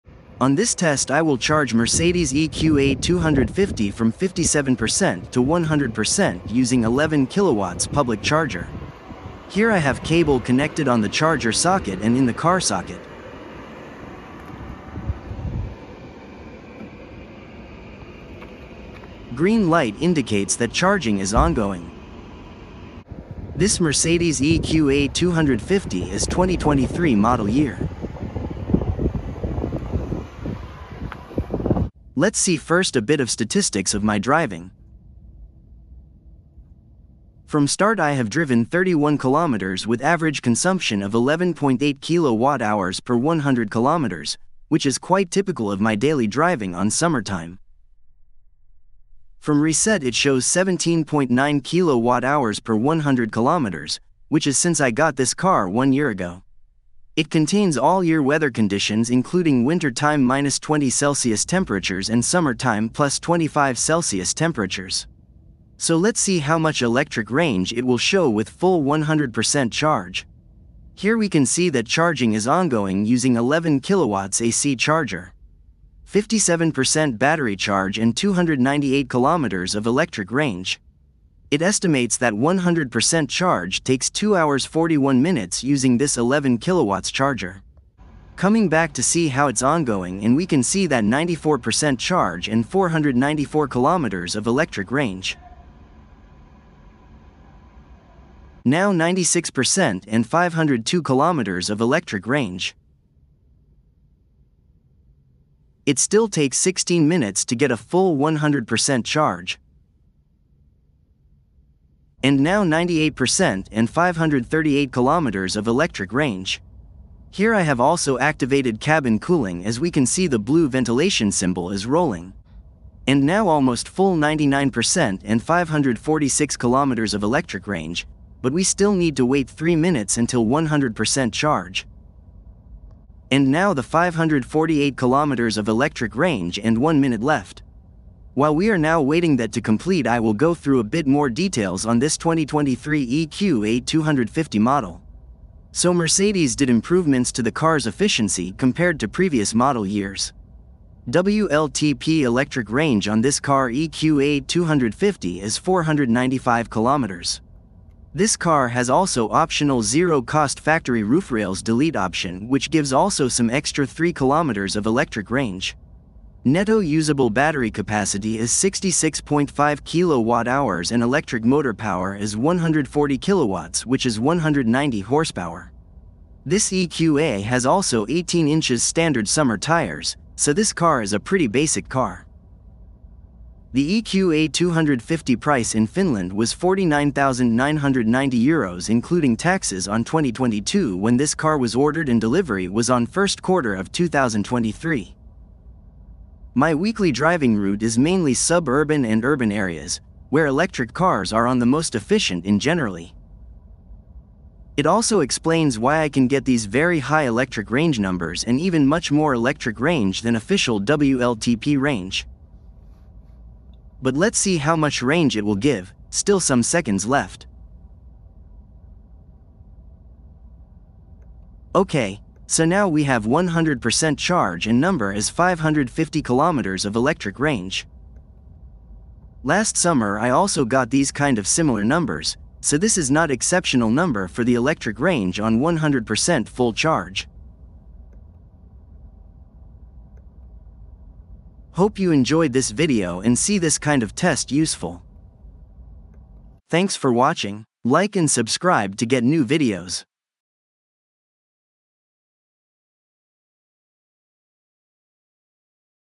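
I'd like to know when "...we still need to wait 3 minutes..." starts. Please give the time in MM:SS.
02:08.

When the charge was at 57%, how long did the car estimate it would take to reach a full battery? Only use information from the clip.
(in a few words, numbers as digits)
2 hours 41 minutes.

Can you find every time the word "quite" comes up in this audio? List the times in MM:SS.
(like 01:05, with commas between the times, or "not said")
00:44.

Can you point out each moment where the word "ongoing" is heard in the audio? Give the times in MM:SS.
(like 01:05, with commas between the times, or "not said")
00:21, 01:12, 01:29.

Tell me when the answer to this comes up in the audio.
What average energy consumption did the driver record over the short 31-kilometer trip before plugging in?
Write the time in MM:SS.
00:41.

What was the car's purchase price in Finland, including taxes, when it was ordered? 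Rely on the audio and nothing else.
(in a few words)
49,990 euros.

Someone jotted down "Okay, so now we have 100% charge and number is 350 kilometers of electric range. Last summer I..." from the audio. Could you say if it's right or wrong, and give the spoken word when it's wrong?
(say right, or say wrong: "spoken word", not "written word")
wrong: "550", not "350".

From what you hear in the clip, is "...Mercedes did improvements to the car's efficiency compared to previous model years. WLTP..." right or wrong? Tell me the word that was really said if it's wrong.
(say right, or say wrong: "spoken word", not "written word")
right.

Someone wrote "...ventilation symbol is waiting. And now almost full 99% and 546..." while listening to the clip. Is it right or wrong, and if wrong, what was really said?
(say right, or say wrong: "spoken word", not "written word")
wrong: "rolling", not "waiting".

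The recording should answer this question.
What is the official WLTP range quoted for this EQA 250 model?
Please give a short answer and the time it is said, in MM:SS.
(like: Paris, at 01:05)
495 km, at 02:35.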